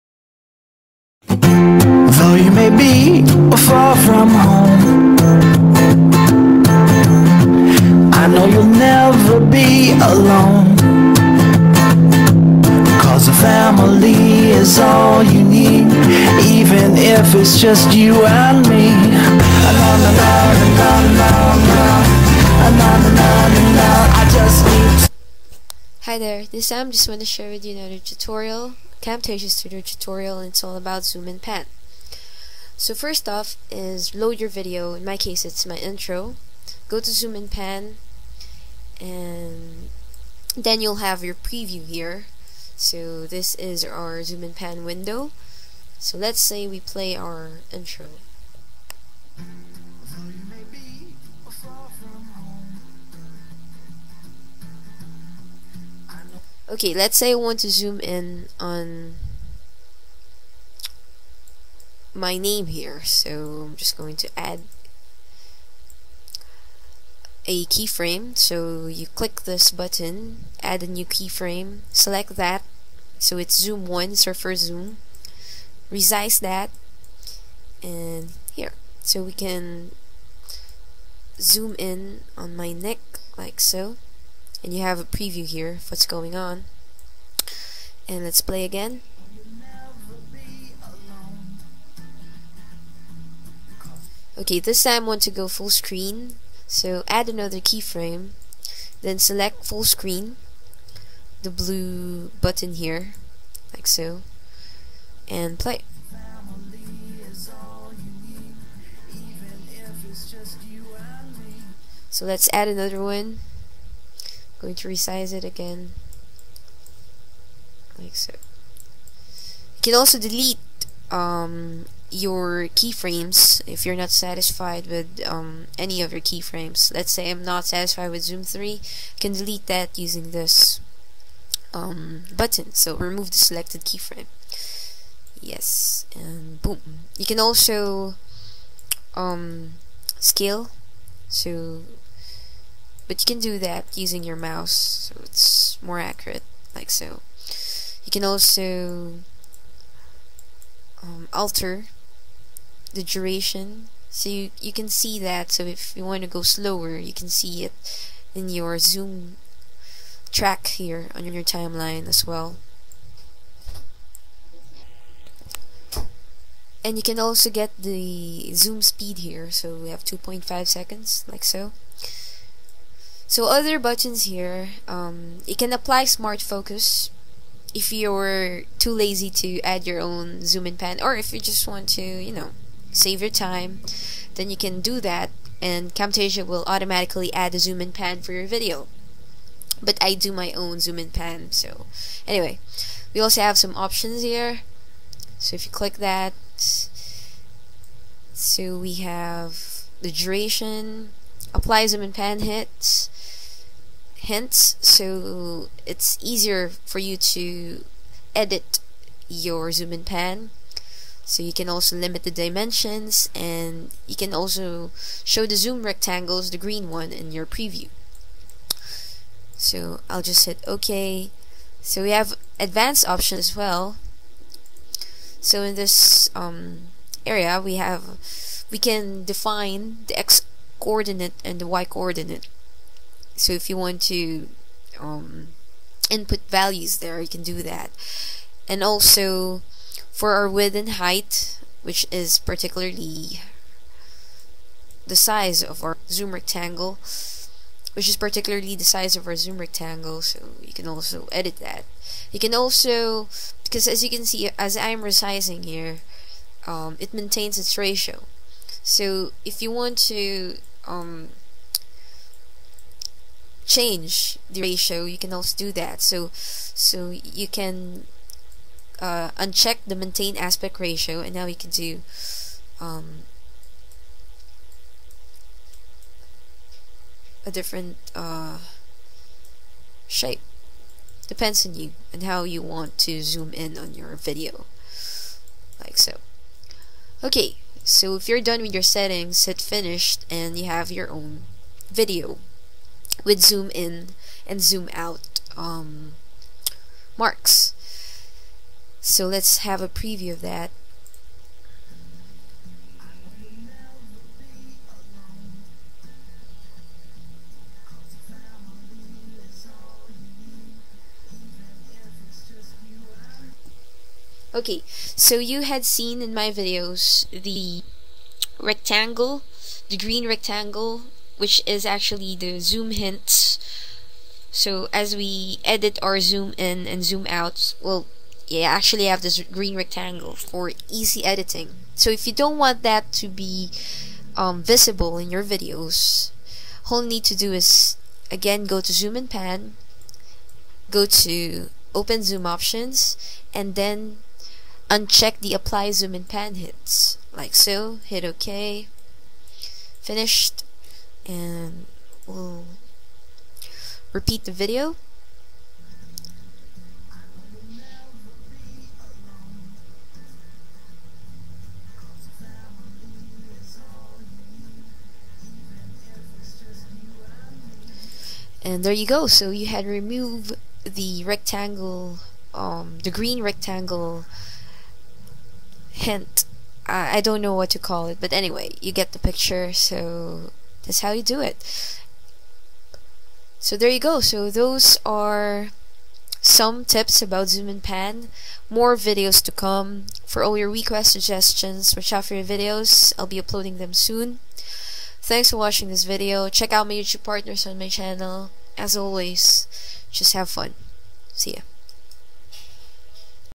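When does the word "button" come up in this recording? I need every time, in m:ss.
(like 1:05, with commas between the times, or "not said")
1:09, 1:42, 2:12, 2:53.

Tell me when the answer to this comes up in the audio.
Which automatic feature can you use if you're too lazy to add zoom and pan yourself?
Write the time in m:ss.
2:56.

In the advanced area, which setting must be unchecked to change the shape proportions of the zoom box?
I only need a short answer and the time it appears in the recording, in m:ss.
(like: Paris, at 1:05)
maintain aspect ratio, at 4:29.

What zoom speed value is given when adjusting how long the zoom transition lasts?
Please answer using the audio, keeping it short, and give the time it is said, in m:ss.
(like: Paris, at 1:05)
2.5 seconds, at 2:50.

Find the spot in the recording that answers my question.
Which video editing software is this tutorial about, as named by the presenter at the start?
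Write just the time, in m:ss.
0:29.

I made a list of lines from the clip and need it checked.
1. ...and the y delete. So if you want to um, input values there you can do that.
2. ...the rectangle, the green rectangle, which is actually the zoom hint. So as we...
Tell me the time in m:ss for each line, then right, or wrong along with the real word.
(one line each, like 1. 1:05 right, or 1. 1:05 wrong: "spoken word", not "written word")
1. 3:51 wrong: "coordinate", not "delete"
2. 5:17 right.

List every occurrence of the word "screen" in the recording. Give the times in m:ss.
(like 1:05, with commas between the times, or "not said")
1:35, 1:39.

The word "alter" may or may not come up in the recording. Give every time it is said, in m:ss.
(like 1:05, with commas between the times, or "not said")
2:31.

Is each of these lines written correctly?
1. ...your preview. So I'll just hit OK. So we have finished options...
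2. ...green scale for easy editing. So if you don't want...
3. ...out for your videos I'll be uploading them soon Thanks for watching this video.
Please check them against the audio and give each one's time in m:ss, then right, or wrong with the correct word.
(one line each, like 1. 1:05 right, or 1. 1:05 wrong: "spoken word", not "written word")
1. 3:37 wrong: "advanced", not "finished"
2. 5:29 wrong: "rectangle", not "scale"
3. 6:32 right.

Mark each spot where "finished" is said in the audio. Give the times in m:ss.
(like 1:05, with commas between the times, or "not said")
4:49, 5:50.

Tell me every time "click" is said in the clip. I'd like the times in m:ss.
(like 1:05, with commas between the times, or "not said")
1:09, 3:15.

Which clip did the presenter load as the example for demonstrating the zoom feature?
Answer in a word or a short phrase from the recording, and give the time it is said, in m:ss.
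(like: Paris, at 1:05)
my intro, at 0:35.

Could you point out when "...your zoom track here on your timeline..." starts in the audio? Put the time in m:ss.
2:38.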